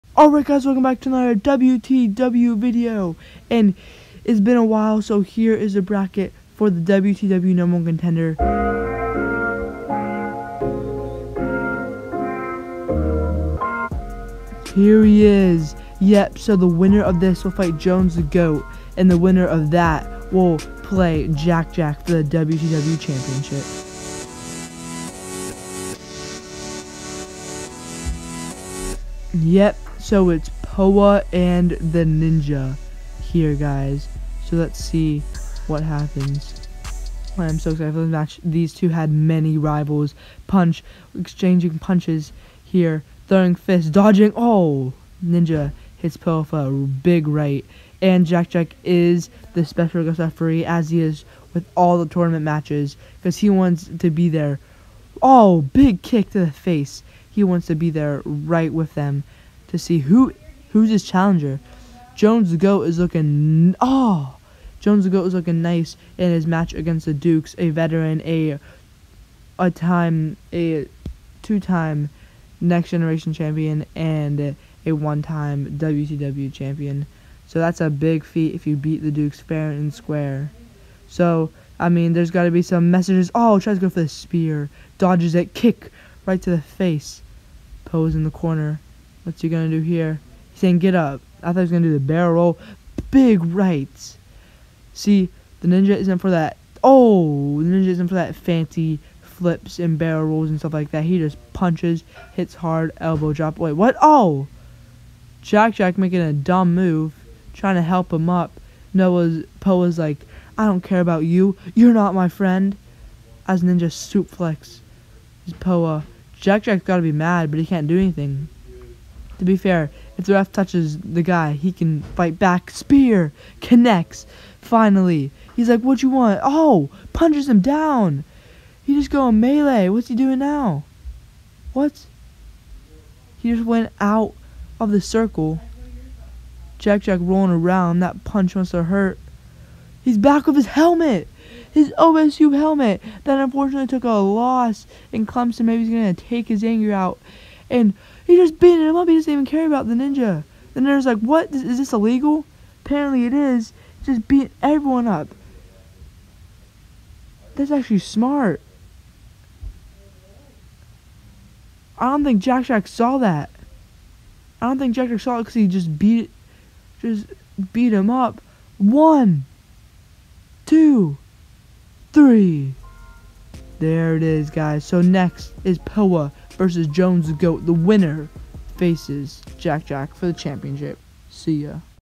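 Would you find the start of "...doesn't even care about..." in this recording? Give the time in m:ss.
2:29.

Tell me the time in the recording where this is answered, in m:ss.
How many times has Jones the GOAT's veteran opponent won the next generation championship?
1:10.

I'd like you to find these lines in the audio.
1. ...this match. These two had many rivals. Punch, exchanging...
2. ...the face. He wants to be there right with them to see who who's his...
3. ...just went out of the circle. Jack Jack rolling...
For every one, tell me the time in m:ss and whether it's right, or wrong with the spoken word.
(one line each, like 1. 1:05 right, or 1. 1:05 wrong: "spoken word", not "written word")
1. 0:38 right
2. 0:56 right
3. 2:13 right.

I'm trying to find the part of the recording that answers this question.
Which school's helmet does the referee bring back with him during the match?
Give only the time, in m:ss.
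2:21.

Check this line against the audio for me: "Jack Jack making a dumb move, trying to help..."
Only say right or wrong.
right.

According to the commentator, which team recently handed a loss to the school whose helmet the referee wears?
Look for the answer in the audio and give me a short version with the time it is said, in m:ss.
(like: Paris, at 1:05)
Clemson, at 2:23.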